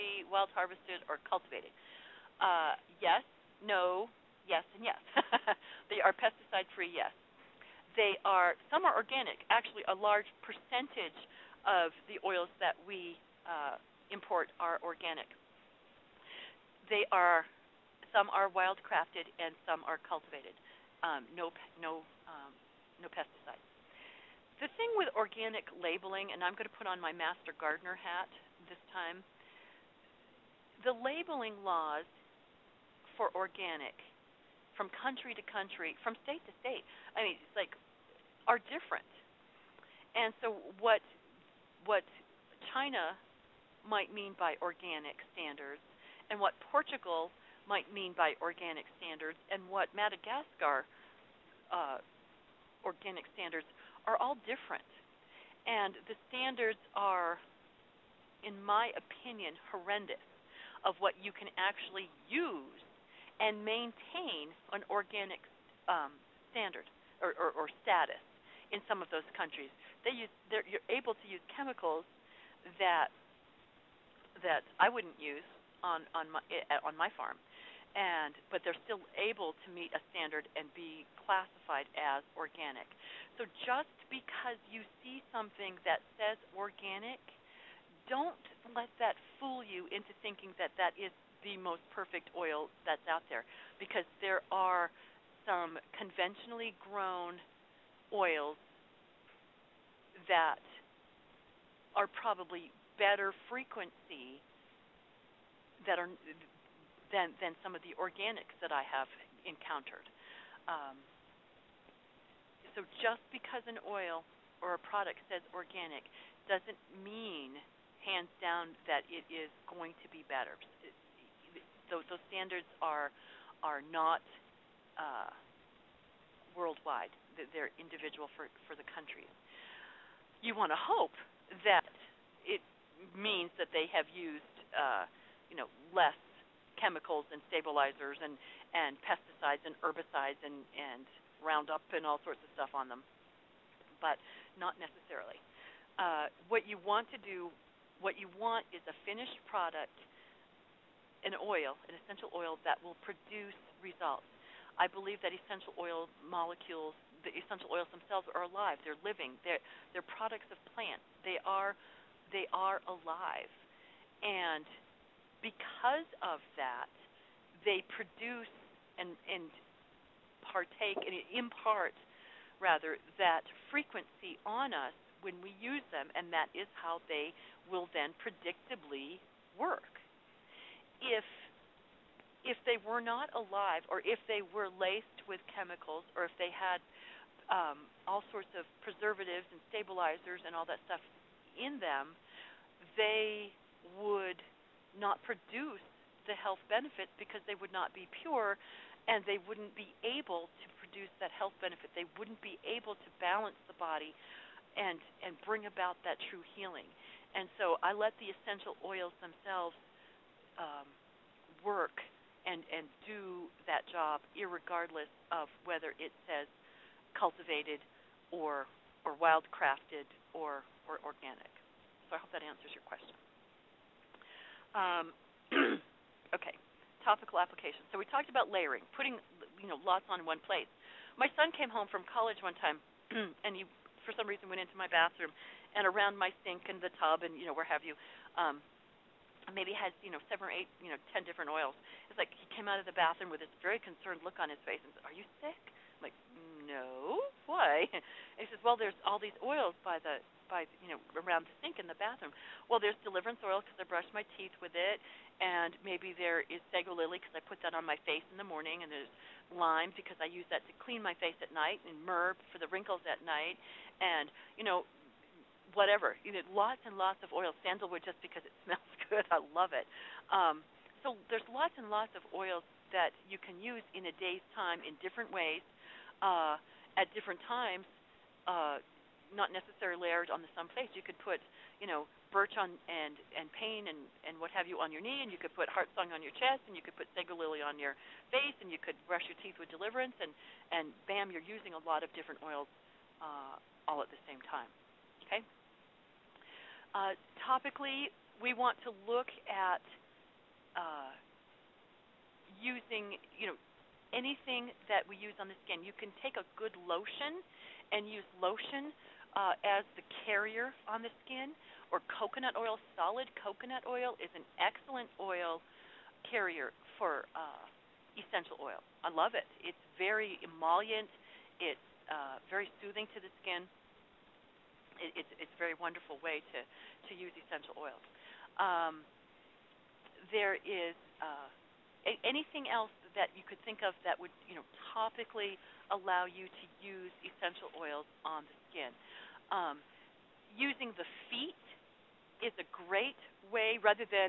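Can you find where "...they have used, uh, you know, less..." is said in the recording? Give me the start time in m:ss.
2:13.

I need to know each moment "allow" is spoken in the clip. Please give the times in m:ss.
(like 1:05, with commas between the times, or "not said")
5:35.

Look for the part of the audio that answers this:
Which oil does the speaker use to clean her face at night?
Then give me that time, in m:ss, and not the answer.
4:19.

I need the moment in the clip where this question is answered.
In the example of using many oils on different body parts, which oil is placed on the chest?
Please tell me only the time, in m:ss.
4:45.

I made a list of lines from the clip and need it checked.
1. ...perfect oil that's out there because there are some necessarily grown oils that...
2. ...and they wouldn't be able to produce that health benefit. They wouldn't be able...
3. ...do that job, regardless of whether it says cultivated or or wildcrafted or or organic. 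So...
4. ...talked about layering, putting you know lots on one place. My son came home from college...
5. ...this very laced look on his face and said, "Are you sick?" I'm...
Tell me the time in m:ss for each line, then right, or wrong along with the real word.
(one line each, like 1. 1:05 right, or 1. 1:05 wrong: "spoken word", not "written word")
1. 1:31 wrong: "conventionally", not "necessarily"
2. 3:19 right
3. 3:33 right
4. 3:48 right
5. 4:03 wrong: "concerned", not "laced".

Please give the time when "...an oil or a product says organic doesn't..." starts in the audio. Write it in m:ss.
1:53.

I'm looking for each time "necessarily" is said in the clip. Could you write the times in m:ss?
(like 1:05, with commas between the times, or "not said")
2:24, 4:39.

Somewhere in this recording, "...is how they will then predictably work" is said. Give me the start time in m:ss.
2:56.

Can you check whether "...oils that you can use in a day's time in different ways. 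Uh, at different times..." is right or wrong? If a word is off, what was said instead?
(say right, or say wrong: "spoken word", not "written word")
right.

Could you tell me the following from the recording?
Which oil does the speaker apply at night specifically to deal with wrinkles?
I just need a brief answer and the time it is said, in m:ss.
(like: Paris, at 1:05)
Myrrh, at 4:22.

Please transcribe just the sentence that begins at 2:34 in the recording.
I believe that essential oil molecules, the essential oils themselves are alive.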